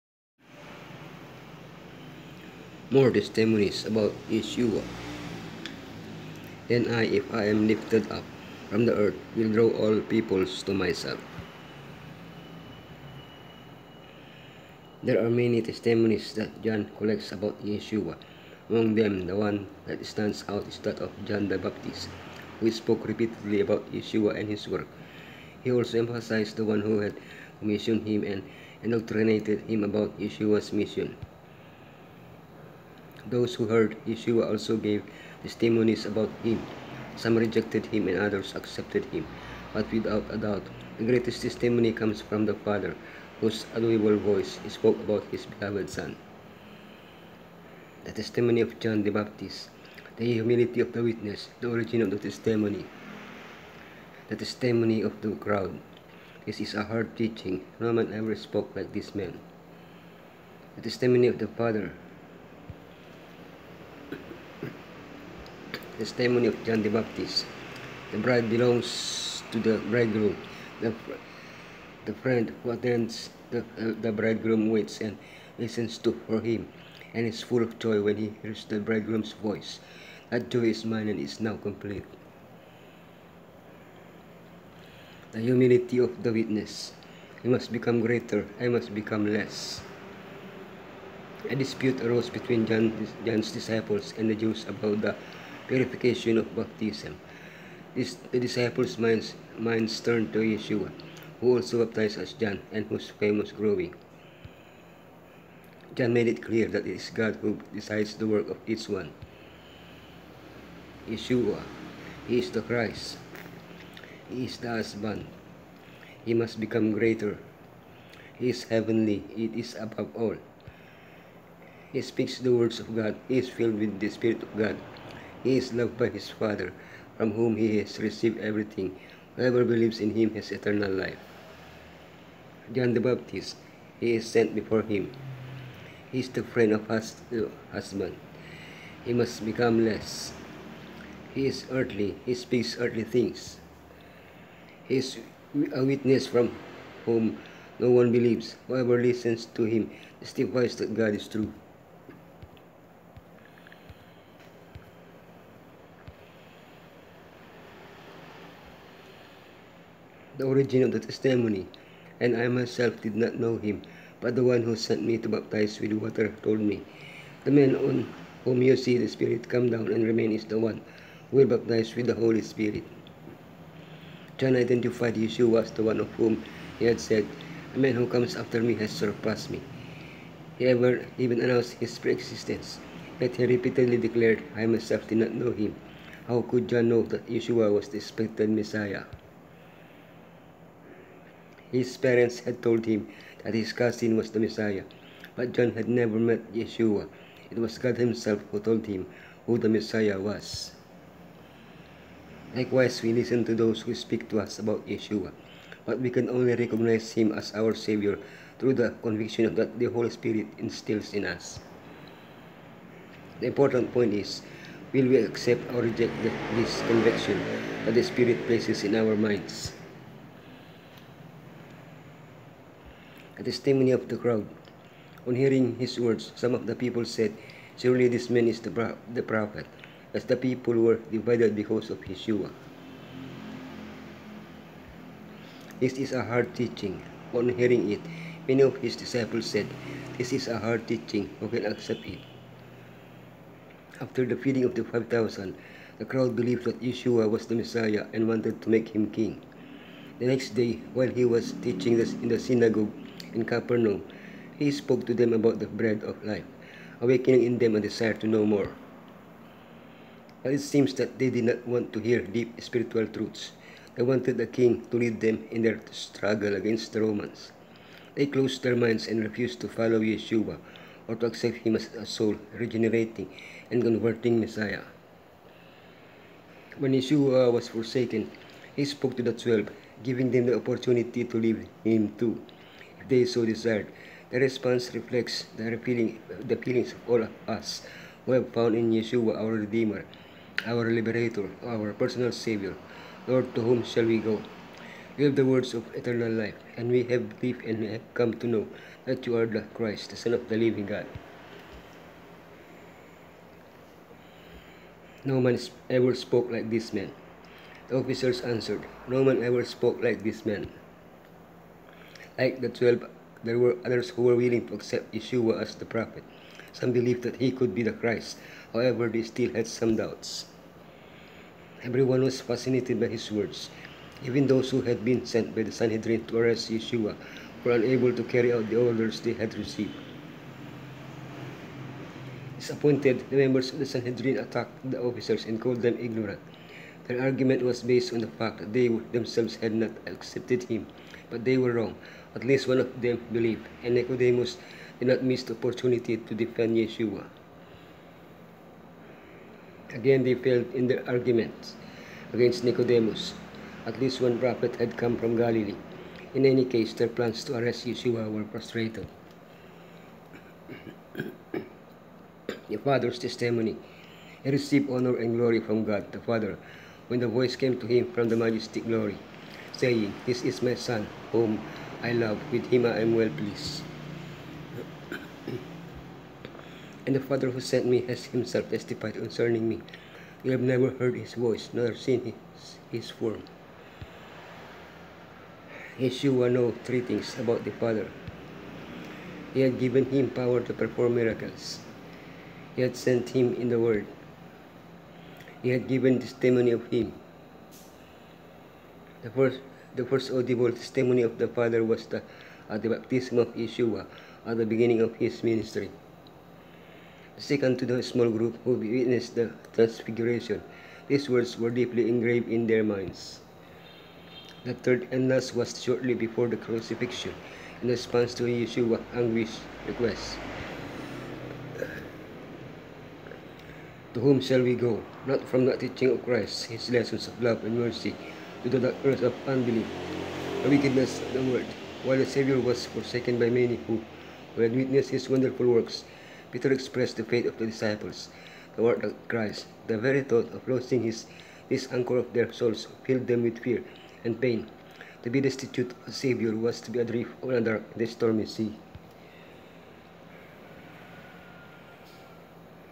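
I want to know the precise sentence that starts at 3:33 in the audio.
The important point is, will we accept or reject this conviction that the Spirit places in our minds?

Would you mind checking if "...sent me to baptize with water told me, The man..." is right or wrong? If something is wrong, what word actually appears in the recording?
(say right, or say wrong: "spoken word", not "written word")
right.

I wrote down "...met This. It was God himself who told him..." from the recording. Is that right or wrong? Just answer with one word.
wrong.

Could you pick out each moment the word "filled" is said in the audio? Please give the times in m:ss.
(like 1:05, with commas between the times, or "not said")
2:03, 7:23.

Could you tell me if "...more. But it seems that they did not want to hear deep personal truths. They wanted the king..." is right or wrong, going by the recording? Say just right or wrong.
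wrong.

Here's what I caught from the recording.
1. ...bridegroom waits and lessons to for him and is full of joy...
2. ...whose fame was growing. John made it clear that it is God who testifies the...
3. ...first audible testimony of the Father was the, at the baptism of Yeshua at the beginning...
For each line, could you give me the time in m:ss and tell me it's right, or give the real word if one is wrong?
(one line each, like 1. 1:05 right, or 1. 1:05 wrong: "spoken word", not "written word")
1. 1:14 wrong: "listens", not "lessons"
2. 1:42 wrong: "decides", not "testifies"
3. 6:40 right.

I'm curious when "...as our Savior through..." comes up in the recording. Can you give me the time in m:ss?
3:27.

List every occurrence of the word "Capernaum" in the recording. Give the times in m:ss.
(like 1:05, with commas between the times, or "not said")
4:13.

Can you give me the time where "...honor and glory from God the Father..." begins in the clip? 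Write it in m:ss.
6:04.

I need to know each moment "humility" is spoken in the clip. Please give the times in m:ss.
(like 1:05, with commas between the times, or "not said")
0:50, 1:25.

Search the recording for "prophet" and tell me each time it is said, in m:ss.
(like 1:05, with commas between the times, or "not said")
3:49, 5:15, 5:54.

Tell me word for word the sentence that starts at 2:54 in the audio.
John identified Yeshua as the one of whom he had said, a man who comes after me has surpassed me.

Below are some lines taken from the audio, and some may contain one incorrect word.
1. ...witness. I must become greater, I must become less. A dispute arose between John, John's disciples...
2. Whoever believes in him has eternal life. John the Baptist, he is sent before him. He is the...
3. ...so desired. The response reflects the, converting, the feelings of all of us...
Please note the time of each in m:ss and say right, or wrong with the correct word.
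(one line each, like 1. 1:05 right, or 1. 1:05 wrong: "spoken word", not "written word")
1. 1:26 right
2. 2:09 right
3. 4:43 wrong: "feeling", not "converting".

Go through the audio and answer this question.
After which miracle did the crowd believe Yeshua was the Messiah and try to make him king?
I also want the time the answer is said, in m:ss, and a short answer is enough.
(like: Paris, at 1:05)
Feeding of the 5,000, at 4:04.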